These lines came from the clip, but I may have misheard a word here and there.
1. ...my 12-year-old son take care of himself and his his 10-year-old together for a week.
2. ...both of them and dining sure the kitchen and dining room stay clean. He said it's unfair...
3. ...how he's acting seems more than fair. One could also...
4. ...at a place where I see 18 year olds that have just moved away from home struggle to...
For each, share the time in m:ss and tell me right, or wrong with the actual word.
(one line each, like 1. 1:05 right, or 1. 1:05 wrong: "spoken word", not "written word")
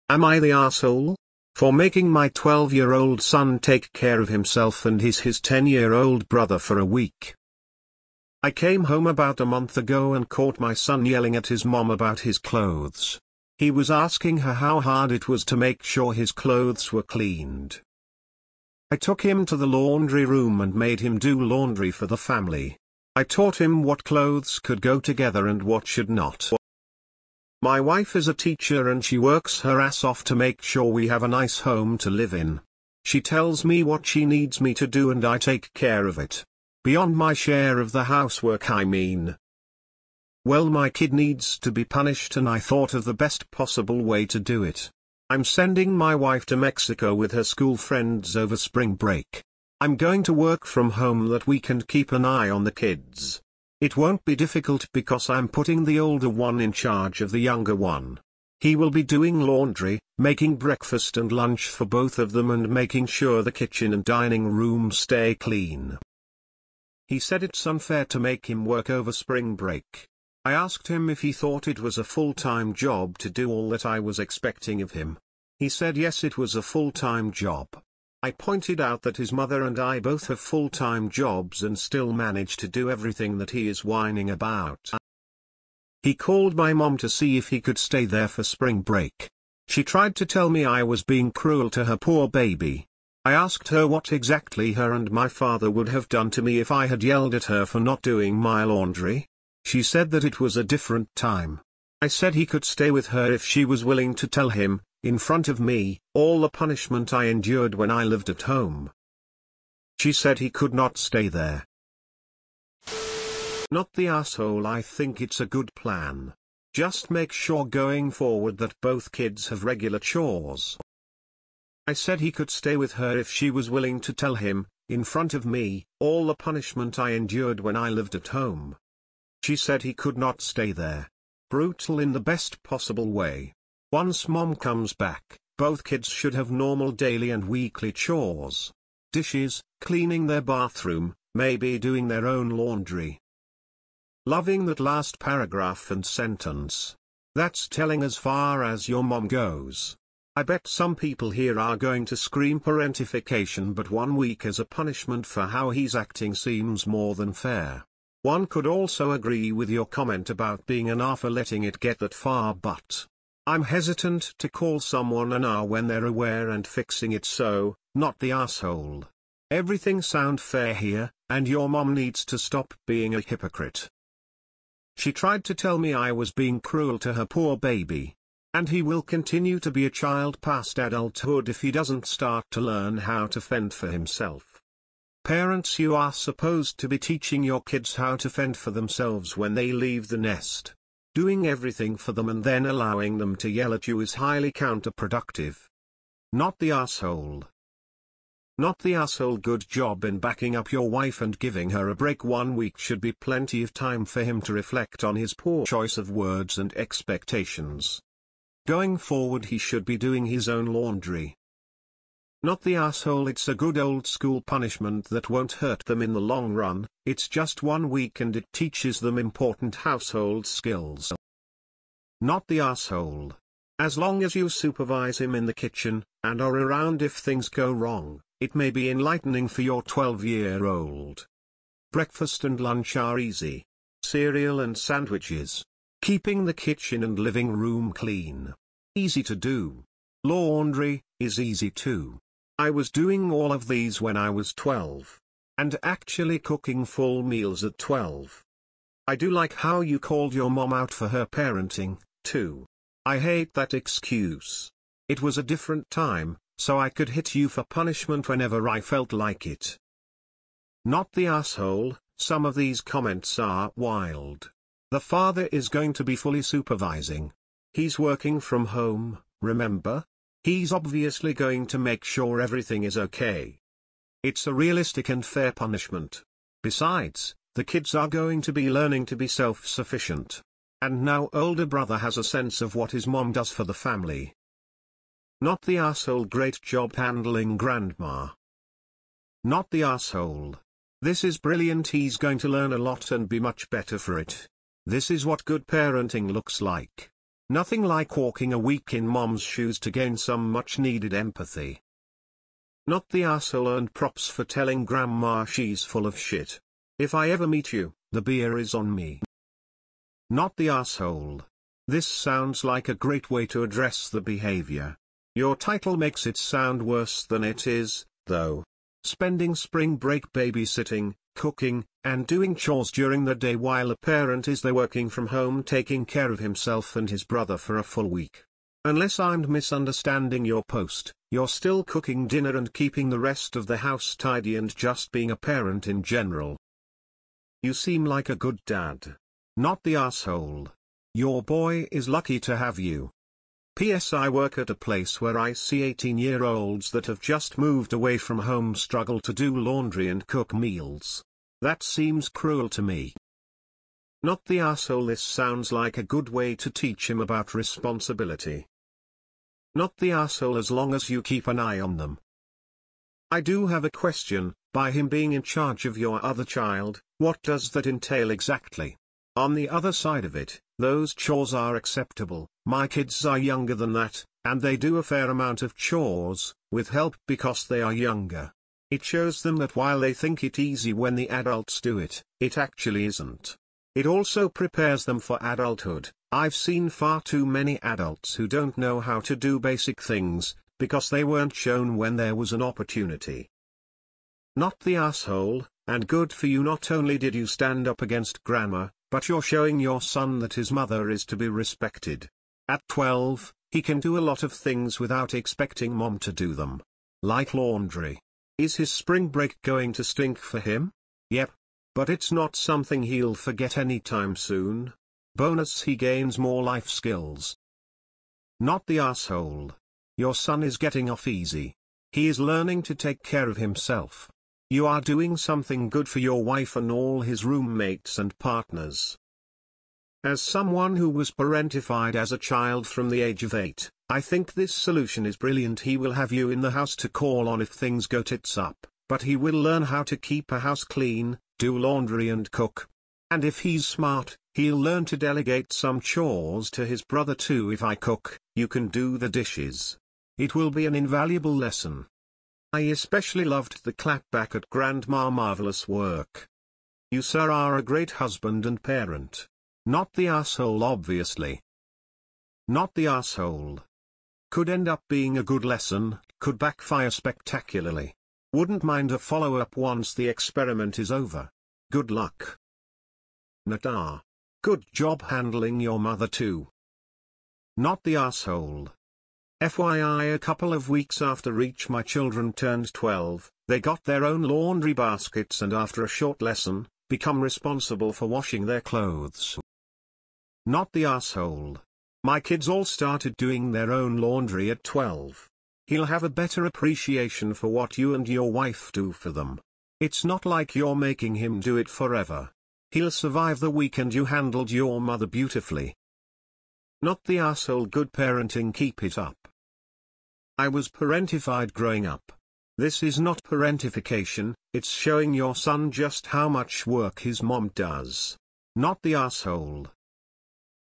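1. 0:02 wrong: "brother", not "together"
2. 1:01 wrong: "making", not "dining"
3. 2:35 right
4. 5:44 right.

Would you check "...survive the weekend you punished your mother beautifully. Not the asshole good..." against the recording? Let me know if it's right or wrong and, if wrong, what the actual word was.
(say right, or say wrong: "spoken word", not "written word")
wrong: "handled", not "punished".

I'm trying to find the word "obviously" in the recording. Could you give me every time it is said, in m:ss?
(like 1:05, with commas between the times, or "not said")
4:30, 7:40.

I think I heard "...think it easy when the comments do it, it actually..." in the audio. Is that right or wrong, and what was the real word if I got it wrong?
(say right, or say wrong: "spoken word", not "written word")
wrong: "adults", not "comments".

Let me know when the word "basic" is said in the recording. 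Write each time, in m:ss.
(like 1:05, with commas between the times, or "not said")
6:29.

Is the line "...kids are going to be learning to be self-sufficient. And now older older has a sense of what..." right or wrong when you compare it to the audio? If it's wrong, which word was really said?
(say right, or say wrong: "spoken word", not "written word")
wrong: "brother", not "older".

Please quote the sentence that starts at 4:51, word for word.
This is brilliant he's going to learn a lot and be much better for it.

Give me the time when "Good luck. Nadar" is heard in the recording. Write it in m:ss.
7:51.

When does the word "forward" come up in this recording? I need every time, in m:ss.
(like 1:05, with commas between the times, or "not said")
1:58, 3:28.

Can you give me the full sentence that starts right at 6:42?
At 12, he can do a lot of things without expecting mom to do them.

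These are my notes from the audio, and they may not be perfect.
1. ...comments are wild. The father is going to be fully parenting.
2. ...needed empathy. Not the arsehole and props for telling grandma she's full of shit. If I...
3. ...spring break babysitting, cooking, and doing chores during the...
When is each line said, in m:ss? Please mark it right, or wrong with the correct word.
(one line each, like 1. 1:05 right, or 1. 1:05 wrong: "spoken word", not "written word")
1. 4:22 wrong: "supervising", not "parenting"
2. 5:00 right
3. 5:19 right.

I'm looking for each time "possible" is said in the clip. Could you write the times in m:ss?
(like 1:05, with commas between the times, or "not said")
0:43, 2:12.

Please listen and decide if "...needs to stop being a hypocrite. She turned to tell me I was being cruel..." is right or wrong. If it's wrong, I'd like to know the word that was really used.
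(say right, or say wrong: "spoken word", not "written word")
wrong: "tried", not "turned".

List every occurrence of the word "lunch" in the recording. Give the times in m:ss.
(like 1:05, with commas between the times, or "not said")
1:01, 3:52.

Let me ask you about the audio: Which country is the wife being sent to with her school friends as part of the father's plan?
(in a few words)
Mexico.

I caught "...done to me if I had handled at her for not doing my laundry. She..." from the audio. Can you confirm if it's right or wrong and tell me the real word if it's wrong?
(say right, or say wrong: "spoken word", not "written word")
wrong: "yelled", not "handled".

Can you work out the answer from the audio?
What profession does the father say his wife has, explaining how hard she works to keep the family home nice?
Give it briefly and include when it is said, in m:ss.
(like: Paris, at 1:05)
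teacher, at 0:28.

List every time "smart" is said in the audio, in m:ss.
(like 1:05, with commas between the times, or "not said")
7:23.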